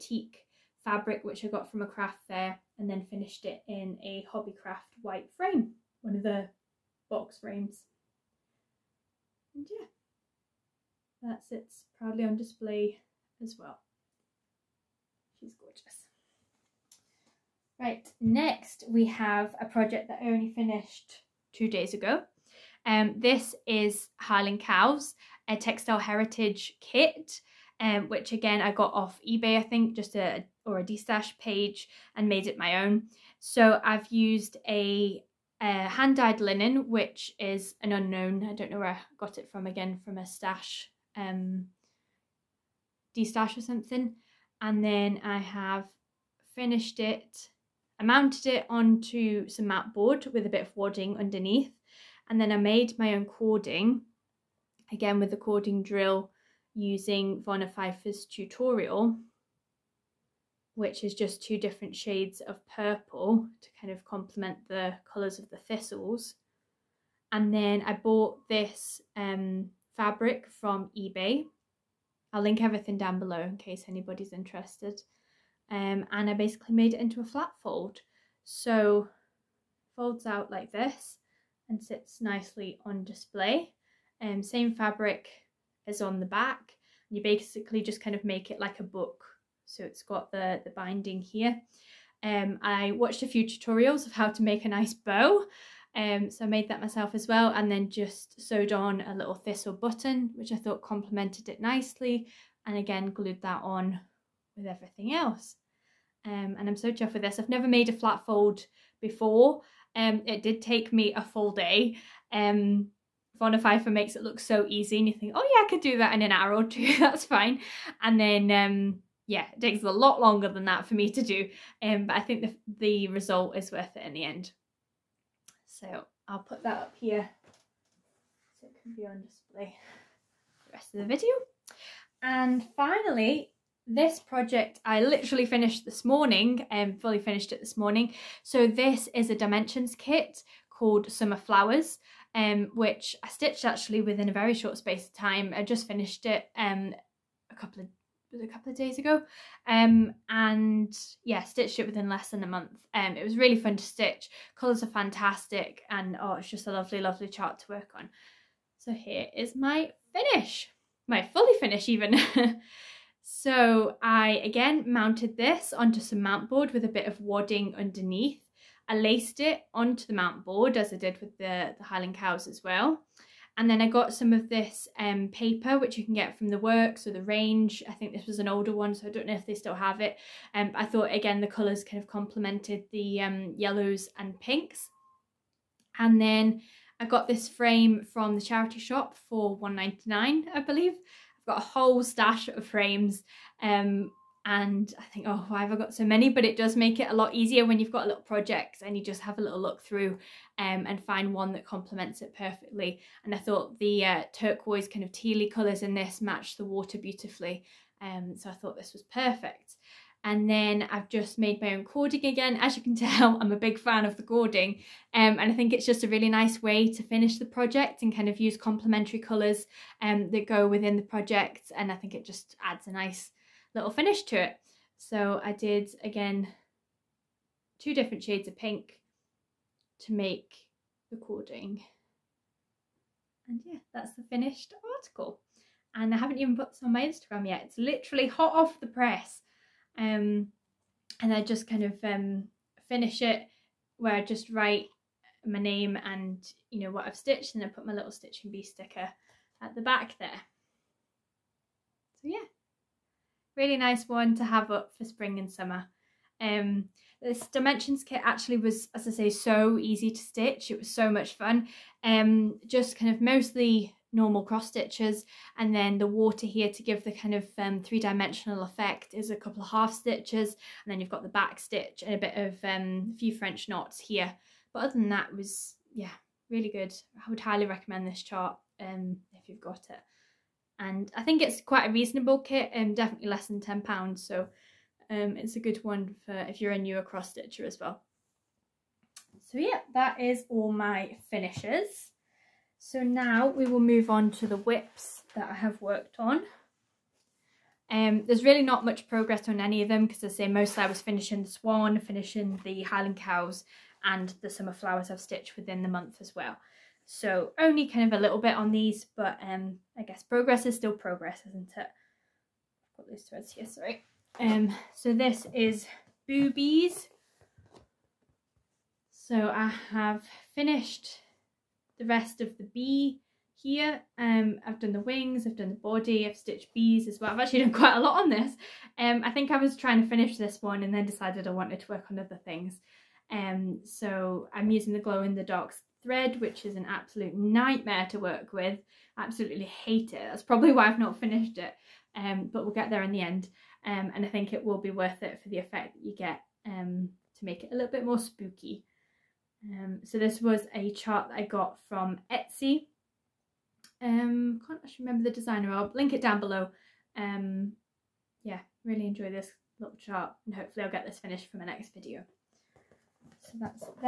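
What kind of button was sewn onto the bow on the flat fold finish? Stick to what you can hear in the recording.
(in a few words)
thistle button.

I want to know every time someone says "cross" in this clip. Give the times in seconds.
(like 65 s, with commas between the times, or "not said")
264 s, 287 s.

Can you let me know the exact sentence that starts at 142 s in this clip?
Um, which I stitched actually within a very short space of time.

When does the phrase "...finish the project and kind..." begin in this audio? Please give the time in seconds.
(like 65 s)
217 s.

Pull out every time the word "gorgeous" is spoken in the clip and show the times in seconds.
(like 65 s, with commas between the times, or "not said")
15 s.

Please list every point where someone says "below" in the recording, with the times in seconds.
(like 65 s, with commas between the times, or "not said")
73 s, 356 s.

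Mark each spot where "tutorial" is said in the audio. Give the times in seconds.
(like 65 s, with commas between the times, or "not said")
58 s, 93 s.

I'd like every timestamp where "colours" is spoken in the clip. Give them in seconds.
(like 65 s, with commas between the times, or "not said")
65 s, 154 s, 181 s, 205 s, 219 s.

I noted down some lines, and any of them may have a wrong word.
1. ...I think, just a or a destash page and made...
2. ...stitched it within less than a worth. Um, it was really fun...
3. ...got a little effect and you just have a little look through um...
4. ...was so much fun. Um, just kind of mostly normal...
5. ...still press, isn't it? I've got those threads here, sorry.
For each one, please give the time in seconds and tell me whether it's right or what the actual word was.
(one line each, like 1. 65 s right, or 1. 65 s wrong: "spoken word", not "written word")
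1. 29 s right
2. 151 s wrong: "month", not "worth"
3. 197 s wrong: "project", not "effect"
4. 260 s right
5. 310 s wrong: "progress", not "press".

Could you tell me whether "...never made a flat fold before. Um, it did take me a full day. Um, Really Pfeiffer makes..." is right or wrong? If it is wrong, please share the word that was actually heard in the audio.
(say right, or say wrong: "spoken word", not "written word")
wrong: "Vonna", not "Really".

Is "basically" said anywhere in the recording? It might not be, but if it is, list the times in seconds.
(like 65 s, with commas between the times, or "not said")
76 s, 87 s.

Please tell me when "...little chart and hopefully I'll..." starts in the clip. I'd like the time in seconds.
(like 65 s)
359 s.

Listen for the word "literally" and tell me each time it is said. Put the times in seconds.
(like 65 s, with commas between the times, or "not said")
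135 s, 237 s.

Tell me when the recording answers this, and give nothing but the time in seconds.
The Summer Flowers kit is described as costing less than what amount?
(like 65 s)
283 s.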